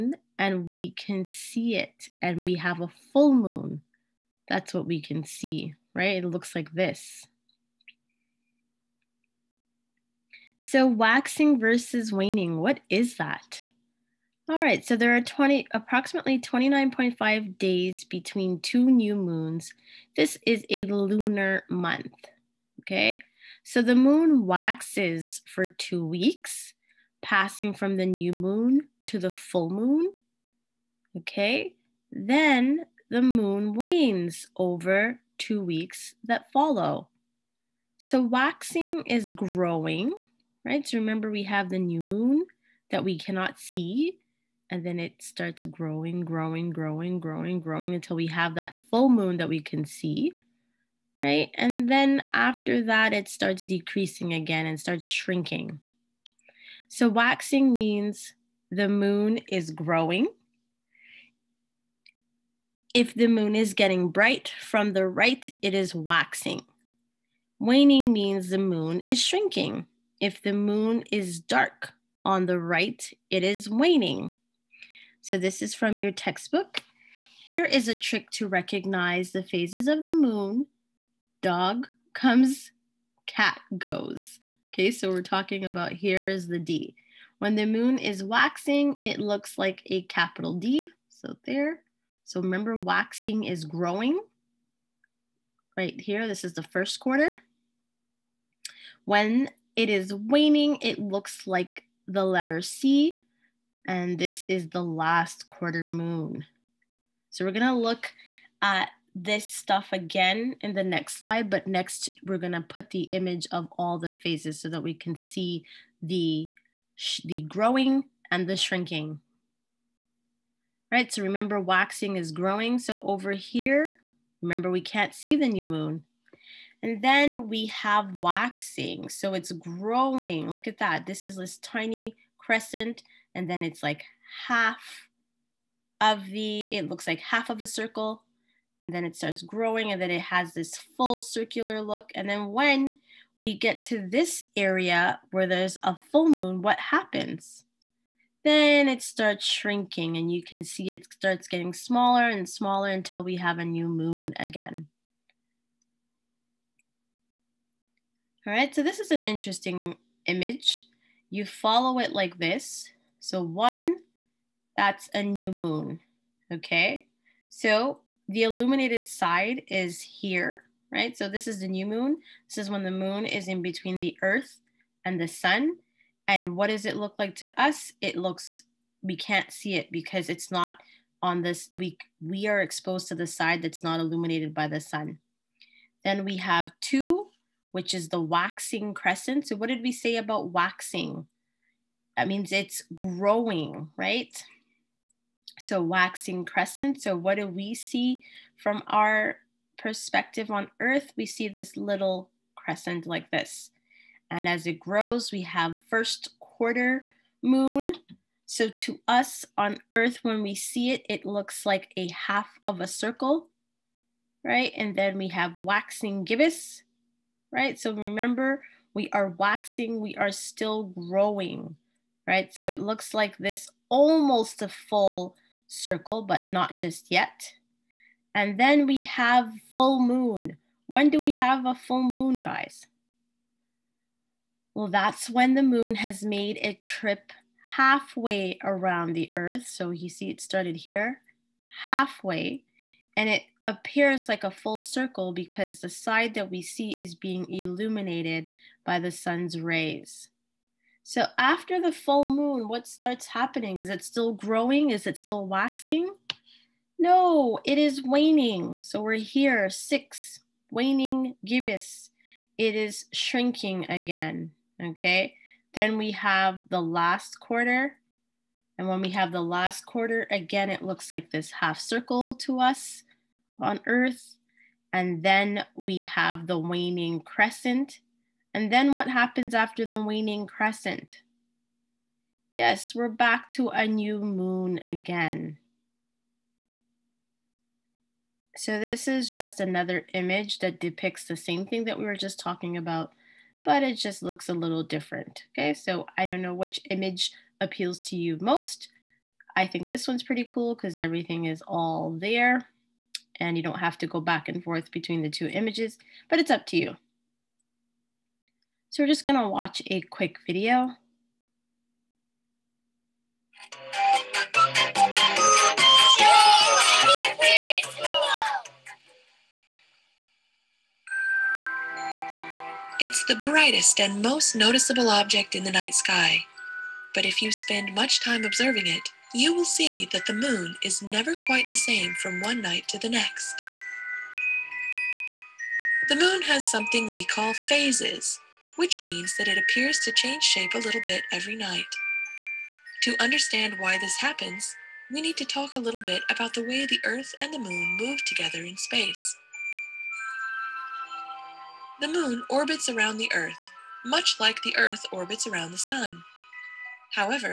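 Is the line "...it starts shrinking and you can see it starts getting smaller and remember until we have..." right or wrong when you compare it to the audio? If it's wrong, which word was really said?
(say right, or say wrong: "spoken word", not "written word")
wrong: "smaller", not "remember".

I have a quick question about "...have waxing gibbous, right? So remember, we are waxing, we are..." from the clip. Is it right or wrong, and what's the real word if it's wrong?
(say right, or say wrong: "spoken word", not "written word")
right.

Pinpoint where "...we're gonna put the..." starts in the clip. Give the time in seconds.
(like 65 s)
112 s.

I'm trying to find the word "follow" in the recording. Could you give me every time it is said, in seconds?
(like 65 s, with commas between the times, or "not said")
36 s, 161 s.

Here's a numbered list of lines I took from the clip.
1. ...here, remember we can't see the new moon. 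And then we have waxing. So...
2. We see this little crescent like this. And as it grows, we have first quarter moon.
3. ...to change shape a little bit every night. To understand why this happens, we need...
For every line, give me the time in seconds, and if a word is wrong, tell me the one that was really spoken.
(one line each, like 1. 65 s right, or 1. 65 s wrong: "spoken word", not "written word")
1. 123 s right
2. 201 s right
3. 339 s right.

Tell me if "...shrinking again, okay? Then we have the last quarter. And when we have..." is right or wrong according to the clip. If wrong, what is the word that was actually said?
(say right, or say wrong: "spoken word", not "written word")
right.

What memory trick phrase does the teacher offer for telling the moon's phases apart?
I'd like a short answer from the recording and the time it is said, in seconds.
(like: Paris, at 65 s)
Dog comes, cat goes, at 81 s.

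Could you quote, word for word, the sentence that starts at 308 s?
So we're just gonna watch a quick video.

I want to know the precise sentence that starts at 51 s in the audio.
And then after that, it starts decreasing again and starts shrinking.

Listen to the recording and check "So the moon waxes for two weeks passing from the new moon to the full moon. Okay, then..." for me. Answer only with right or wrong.
right.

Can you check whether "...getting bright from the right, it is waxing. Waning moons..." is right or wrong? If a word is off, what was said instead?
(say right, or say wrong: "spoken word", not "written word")
wrong: "means", not "moons".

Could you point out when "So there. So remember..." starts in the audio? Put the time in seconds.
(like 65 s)
91 s.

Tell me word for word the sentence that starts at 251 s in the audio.
So after the full moon, what starts happening?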